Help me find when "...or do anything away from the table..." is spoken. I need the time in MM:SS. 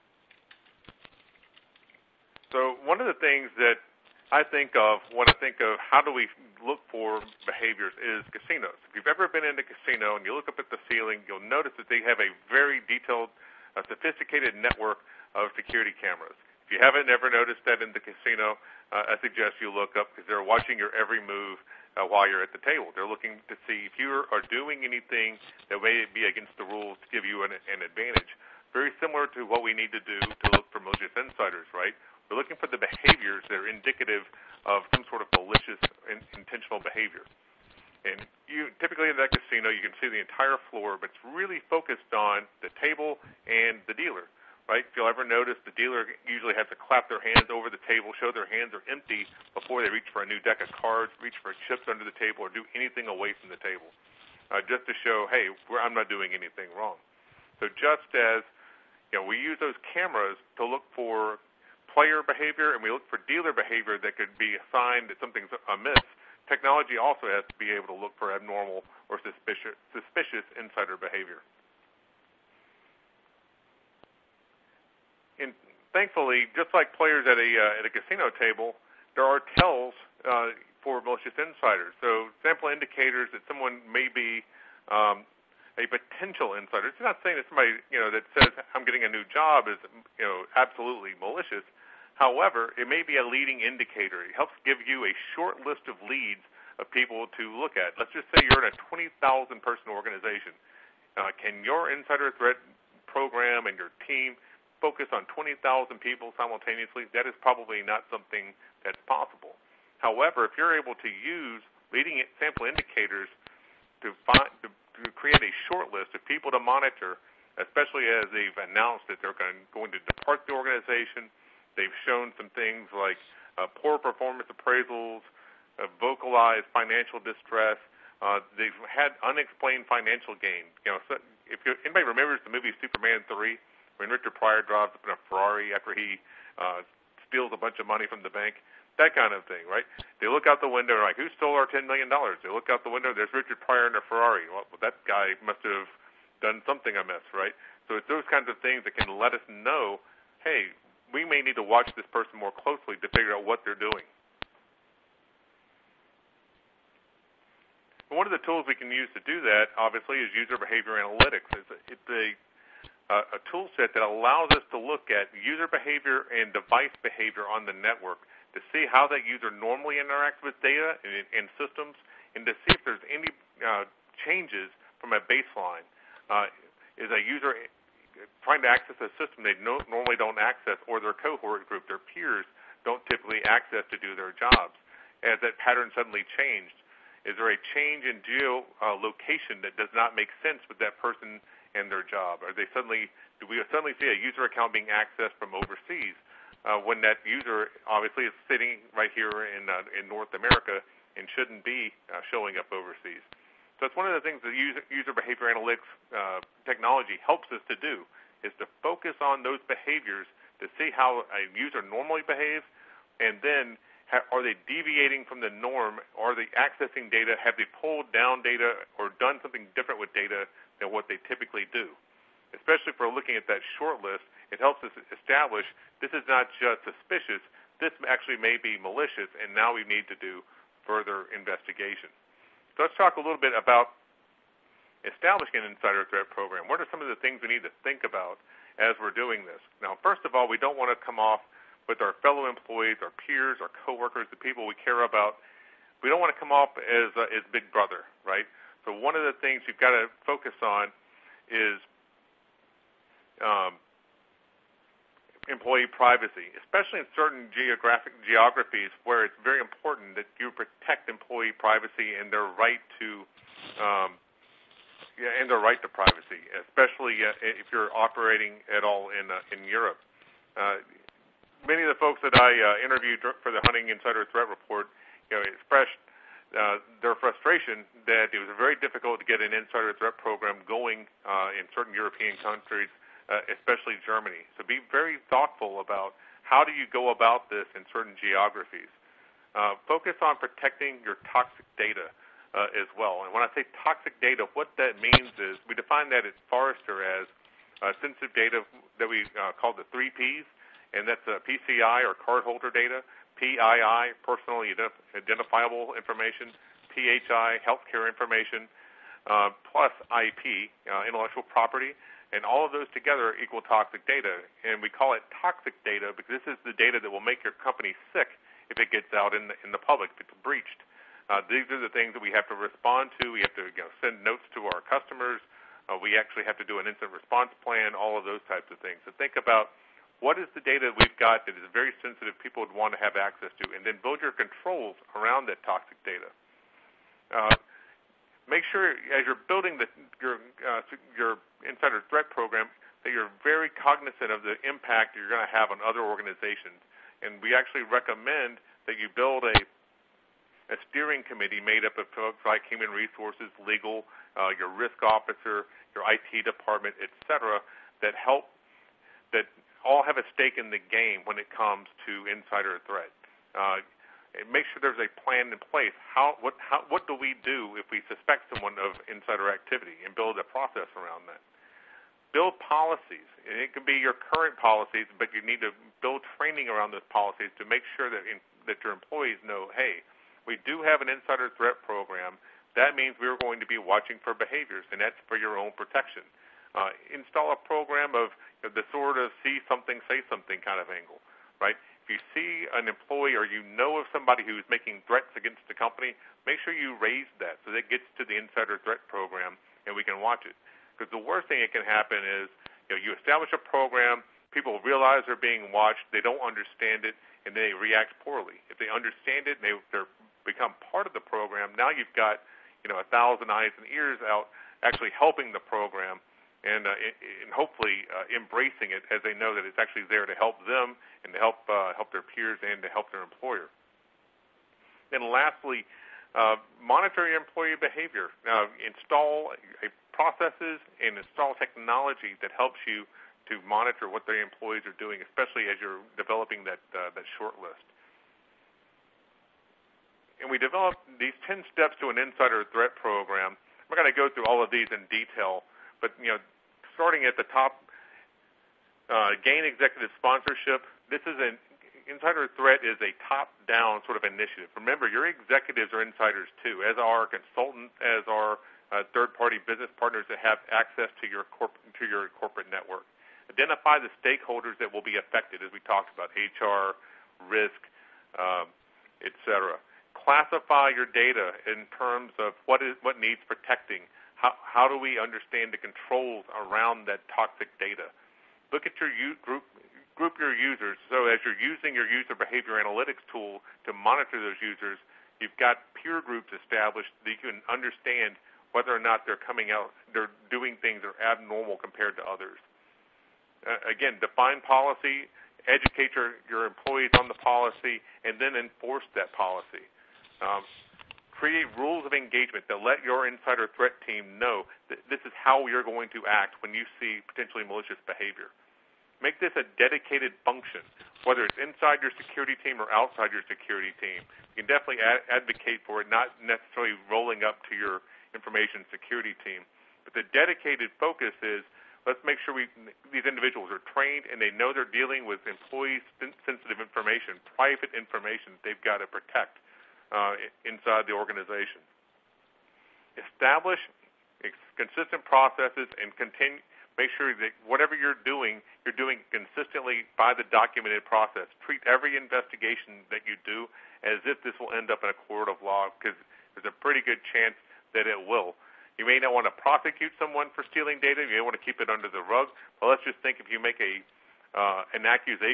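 00:52.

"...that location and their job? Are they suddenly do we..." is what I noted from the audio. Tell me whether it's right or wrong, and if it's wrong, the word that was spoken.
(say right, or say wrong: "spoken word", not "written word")
wrong: "person", not "location".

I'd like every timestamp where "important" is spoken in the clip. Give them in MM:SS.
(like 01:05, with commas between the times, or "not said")
04:19.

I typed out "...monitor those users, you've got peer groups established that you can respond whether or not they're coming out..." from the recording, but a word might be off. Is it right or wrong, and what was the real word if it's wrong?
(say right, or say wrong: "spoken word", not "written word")
wrong: "understand", not "respond".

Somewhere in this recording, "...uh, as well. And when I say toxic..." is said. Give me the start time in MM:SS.
04:52.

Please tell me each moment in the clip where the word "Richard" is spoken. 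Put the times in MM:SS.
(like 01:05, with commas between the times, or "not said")
02:14, 02:23.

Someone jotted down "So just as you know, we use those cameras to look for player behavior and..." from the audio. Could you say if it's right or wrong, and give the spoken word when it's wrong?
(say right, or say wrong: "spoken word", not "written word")
right.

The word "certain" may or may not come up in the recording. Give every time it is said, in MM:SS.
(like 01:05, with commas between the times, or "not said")
04:17, 04:41, 04:47.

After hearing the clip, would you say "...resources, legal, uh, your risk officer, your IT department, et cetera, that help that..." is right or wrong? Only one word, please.
right.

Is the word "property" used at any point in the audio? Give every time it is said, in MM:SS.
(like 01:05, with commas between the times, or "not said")
05:11.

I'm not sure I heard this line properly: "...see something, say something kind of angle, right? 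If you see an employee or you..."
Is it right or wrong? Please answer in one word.
right.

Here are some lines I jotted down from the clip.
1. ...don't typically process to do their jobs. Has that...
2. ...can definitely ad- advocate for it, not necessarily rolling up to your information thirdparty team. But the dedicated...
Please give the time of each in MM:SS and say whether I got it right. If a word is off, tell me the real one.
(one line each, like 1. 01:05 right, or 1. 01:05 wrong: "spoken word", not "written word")
1. 03:02 wrong: "access", not "process"
2. 08:34 wrong: "security", not "thirdparty".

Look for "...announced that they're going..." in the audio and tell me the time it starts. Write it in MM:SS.
01:58.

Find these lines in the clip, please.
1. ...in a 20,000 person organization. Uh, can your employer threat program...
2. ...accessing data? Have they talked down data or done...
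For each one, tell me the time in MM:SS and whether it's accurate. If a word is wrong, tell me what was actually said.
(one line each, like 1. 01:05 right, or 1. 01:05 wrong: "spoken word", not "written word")
1. 01:38 wrong: "insider", not "employer"
2. 03:36 wrong: "pulled", not "talked".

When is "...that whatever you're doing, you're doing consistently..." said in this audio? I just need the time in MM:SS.
08:57.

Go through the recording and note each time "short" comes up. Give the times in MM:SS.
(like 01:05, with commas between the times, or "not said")
01:35, 01:55, 03:43, 07:17.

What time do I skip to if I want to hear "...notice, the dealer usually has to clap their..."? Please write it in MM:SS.
00:45.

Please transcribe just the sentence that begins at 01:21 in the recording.
So sample indicators that someone may be um, a potential insider.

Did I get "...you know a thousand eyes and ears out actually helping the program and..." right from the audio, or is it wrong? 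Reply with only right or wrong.
right.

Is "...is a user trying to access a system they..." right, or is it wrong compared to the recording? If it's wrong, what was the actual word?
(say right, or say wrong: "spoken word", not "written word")
right.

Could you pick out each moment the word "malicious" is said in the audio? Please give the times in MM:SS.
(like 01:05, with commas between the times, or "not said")
00:30, 00:35, 01:21, 01:31, 03:48, 08:27.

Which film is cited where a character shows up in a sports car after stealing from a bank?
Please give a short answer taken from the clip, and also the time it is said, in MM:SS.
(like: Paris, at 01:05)
Superman 3, at 02:12.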